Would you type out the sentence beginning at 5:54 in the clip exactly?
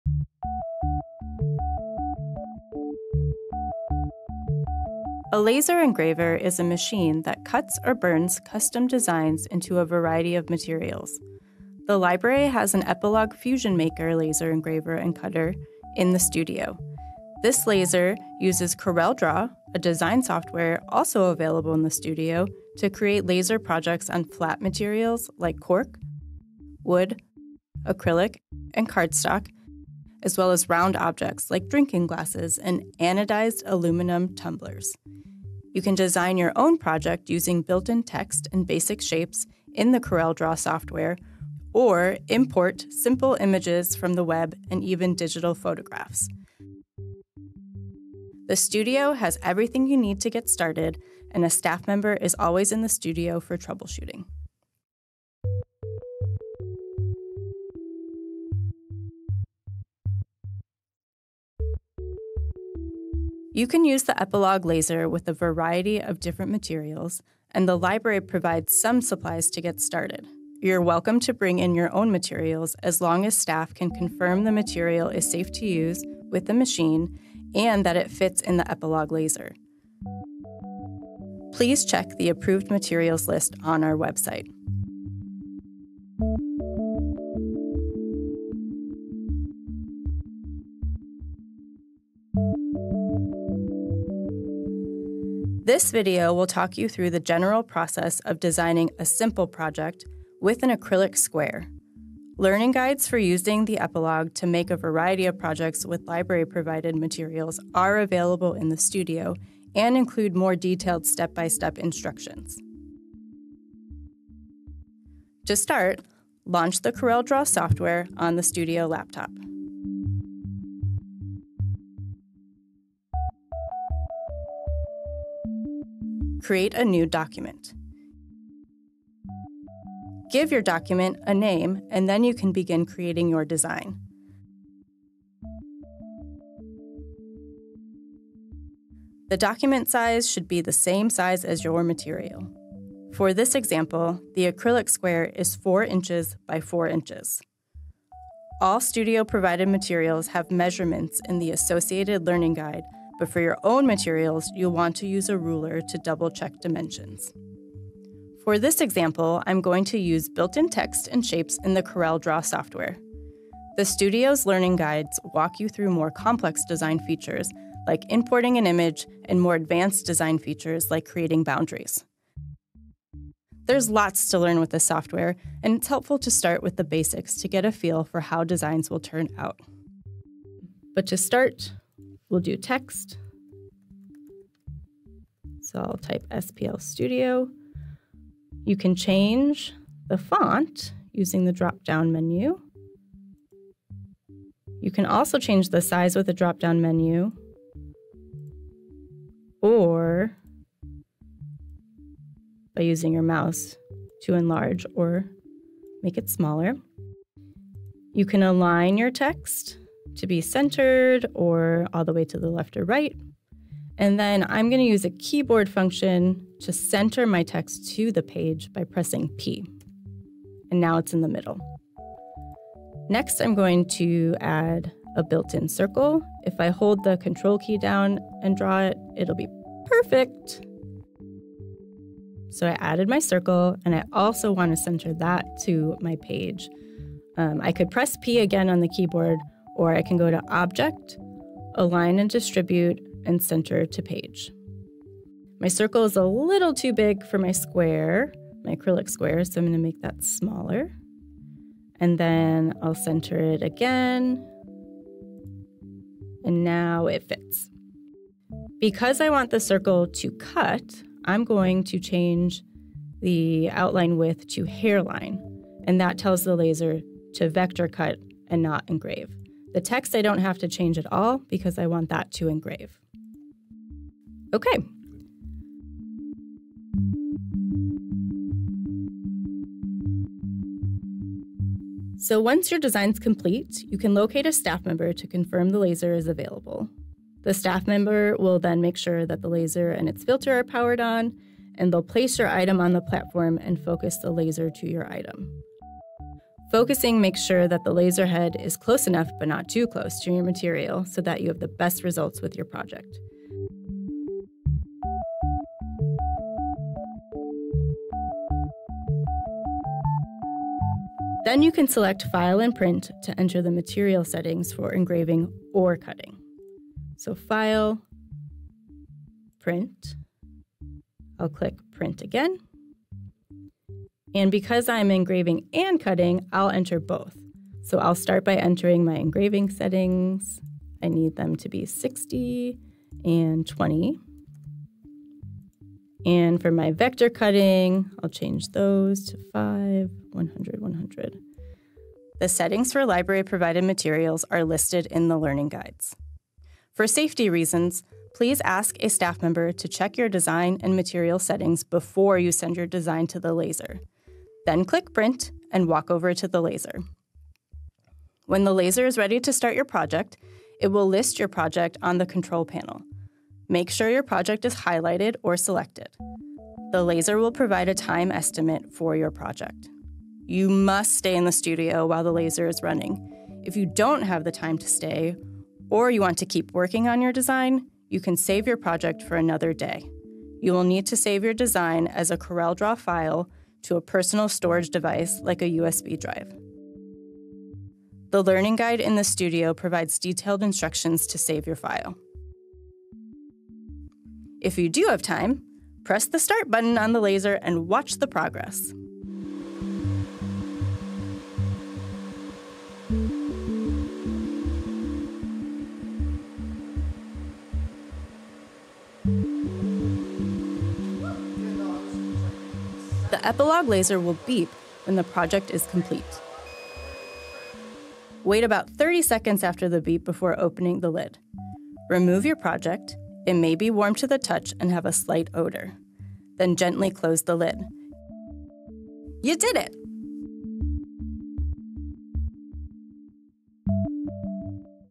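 Then click Print and walk over to the laser.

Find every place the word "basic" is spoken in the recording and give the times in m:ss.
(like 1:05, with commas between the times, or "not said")
0:38, 2:56.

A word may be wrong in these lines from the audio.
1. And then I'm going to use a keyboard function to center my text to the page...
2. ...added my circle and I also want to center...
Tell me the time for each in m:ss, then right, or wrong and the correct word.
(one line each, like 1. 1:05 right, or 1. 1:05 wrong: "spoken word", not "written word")
1. 3:33 right
2. 3:52 right.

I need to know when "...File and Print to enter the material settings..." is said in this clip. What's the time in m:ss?
5:12.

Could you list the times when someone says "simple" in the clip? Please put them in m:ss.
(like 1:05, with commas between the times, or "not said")
0:42, 1:39.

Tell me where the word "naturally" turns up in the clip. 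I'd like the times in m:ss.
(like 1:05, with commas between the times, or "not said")
not said.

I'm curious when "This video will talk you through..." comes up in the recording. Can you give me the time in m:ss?
1:35.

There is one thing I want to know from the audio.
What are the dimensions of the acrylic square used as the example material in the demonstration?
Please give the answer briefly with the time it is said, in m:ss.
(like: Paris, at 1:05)
4 inches by 4 inches, at 2:25.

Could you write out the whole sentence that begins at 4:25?
And that tells the laser to vector cut and not engrave.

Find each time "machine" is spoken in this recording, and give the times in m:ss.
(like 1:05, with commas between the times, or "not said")
0:06, 1:16.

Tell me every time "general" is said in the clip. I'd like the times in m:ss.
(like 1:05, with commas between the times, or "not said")
1:37.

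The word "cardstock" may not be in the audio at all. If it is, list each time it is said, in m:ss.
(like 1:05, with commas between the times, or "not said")
0:28.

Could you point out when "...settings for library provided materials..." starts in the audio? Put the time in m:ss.
5:42.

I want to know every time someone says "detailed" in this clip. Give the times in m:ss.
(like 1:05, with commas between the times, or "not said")
1:50, 6:30.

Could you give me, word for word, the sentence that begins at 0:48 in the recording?
The studio has everything you need to get started, and a staff member is always in the studio for troubleshooting.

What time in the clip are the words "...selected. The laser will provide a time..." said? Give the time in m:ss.
6:05.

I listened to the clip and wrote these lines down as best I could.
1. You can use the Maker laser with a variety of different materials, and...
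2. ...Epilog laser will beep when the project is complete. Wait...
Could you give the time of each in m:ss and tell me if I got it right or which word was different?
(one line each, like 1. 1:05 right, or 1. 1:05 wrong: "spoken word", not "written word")
1. 1:03 wrong: "Epilog", not "Maker"
2. 6:53 right.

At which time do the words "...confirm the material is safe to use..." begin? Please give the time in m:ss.
1:13.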